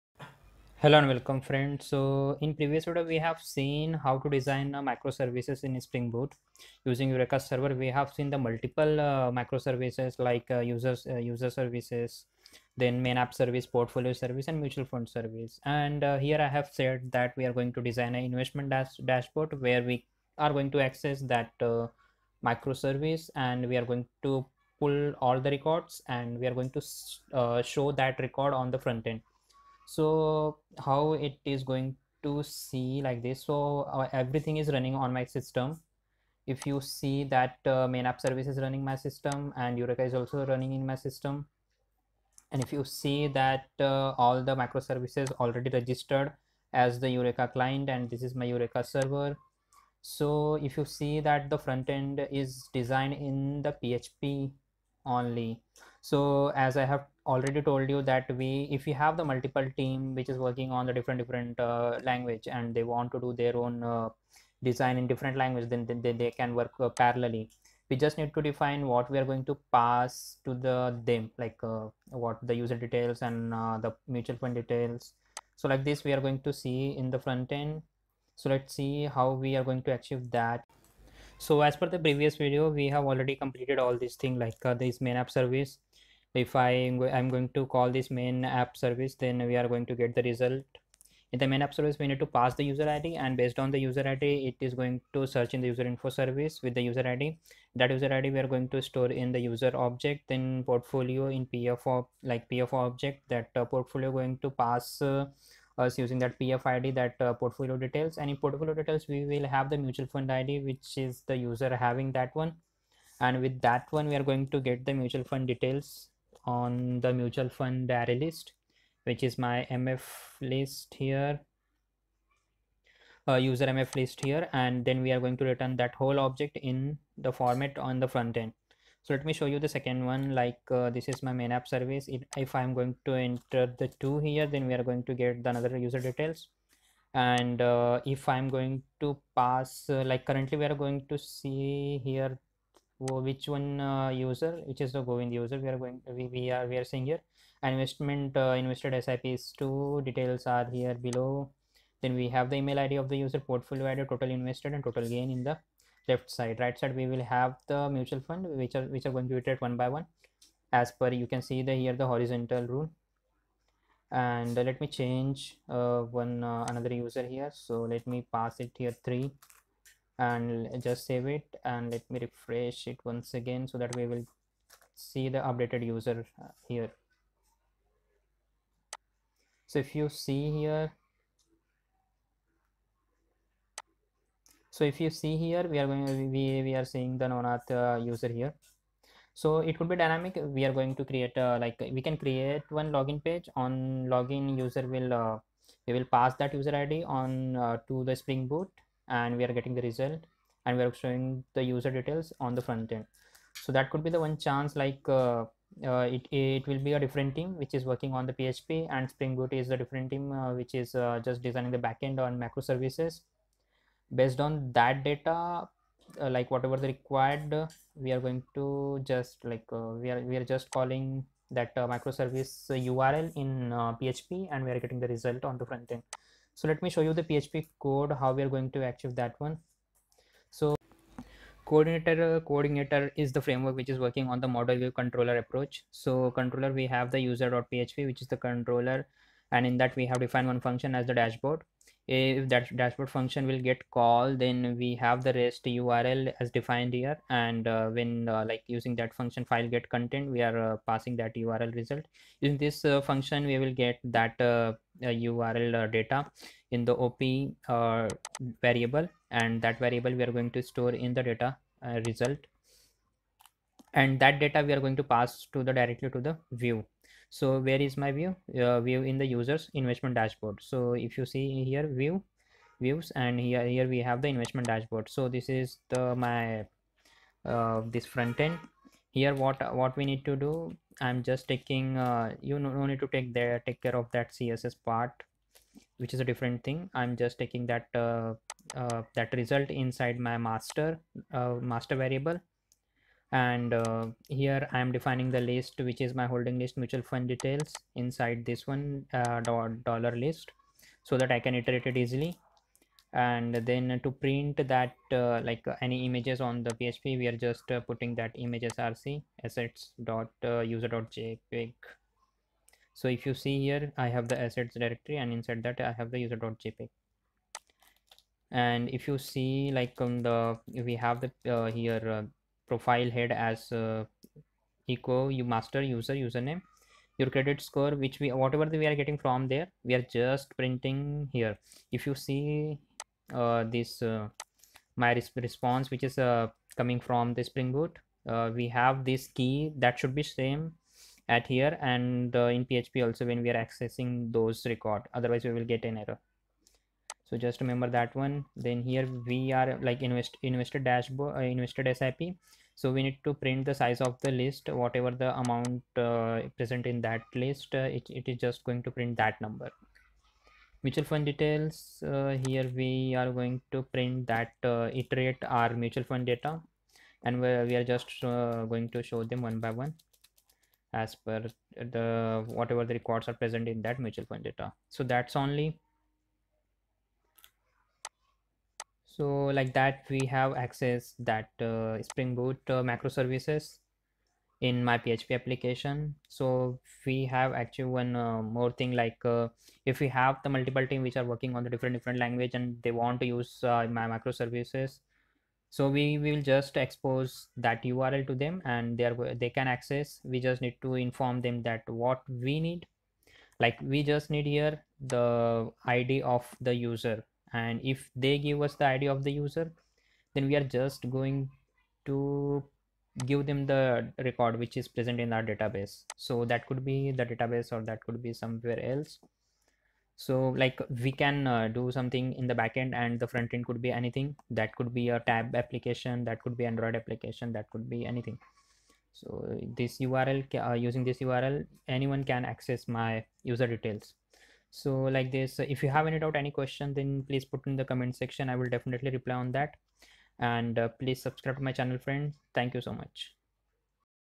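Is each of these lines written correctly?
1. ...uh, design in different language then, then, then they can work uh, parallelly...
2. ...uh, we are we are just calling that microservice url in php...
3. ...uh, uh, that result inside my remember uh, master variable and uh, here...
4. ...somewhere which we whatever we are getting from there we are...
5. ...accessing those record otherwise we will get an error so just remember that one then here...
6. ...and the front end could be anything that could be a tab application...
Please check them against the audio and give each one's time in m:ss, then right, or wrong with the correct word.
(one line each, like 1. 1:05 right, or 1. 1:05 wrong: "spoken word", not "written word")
1. 1:03 right
2. 3:39 right
3. 4:47 wrong: "master", not "remember"
4. 5:27 wrong: "score", not "somewhere"
5. 5:43 right
6. 7:02 right.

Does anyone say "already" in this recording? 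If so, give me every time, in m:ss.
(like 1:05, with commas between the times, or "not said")
0:45, 0:57, 1:23.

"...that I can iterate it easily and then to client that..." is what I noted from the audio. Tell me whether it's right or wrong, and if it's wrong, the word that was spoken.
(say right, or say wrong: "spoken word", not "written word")
wrong: "print", not "client".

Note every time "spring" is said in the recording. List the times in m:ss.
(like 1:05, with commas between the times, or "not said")
0:05, 3:18, 3:29, 5:37, 6:22.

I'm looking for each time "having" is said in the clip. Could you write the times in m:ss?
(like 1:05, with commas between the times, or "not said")
1:51.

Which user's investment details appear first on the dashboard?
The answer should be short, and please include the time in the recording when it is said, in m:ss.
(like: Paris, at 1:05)
Govind, at 2:25.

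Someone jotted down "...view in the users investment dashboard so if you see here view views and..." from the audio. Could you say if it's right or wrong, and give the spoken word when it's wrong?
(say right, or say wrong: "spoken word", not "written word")
right.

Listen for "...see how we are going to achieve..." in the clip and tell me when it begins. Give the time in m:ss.
1:18.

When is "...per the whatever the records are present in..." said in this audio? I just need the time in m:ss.
6:11.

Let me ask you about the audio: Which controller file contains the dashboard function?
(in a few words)
user.php.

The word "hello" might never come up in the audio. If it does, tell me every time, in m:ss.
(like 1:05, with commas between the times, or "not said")
0:00.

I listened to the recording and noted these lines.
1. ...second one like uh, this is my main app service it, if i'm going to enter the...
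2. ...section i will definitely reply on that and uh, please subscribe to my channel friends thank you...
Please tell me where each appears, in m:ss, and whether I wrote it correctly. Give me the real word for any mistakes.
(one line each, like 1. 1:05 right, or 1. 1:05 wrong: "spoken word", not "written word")
1. 2:09 right
2. 7:18 right.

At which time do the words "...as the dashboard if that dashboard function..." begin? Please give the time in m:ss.
4:00.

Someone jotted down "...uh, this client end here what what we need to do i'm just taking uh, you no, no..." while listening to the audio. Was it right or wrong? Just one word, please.
wrong.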